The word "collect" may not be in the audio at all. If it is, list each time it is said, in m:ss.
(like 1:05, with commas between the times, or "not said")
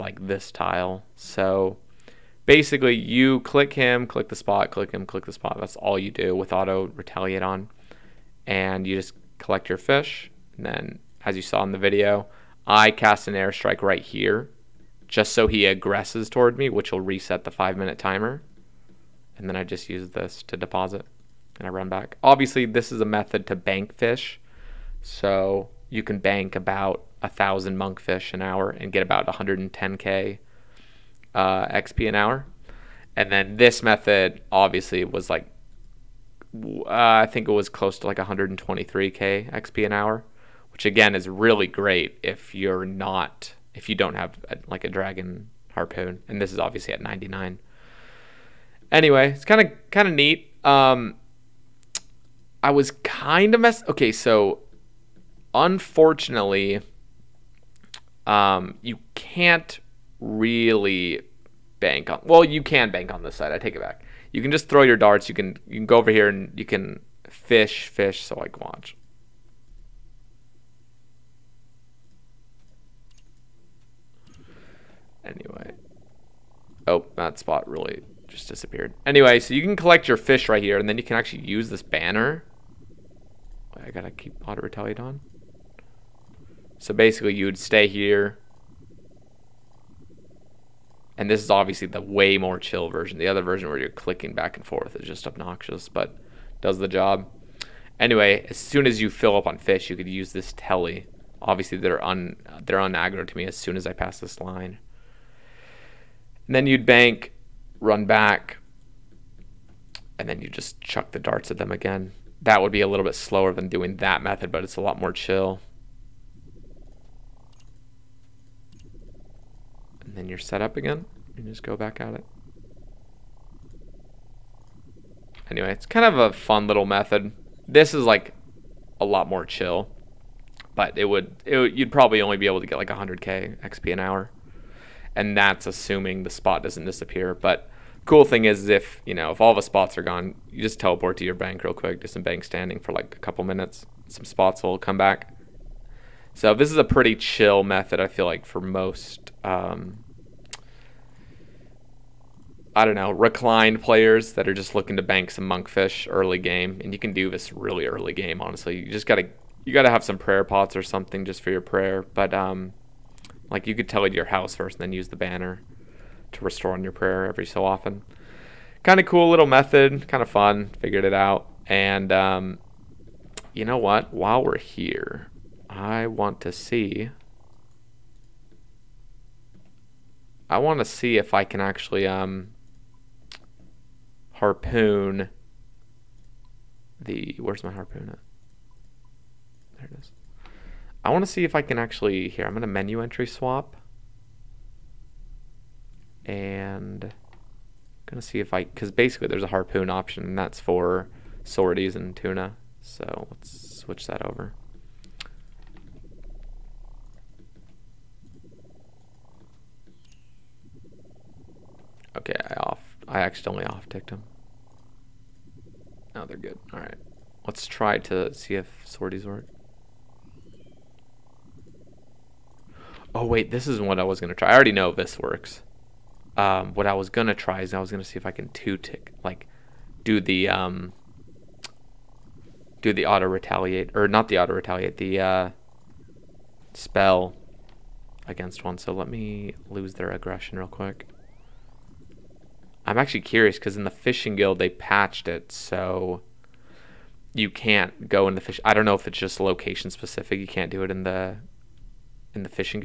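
0:09, 1:19.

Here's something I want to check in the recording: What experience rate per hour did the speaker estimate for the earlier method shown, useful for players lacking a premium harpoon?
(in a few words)
123k.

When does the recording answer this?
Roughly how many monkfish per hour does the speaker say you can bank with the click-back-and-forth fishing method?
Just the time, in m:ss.
0:27.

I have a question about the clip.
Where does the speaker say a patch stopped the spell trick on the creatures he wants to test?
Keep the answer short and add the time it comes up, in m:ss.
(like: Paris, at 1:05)
fishing guild, at 4:03.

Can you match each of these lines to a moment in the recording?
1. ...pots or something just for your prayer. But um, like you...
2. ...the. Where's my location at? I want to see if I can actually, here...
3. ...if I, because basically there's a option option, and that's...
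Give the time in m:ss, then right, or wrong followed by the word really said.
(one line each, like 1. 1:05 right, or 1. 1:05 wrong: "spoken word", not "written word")
1. 2:40 right
2. 3:07 wrong: "harpoon", not "location"
3. 3:18 wrong: "harpoon", not "option".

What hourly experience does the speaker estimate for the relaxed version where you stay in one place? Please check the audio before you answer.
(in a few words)
100k.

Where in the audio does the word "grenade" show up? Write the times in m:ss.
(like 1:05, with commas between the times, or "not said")
not said.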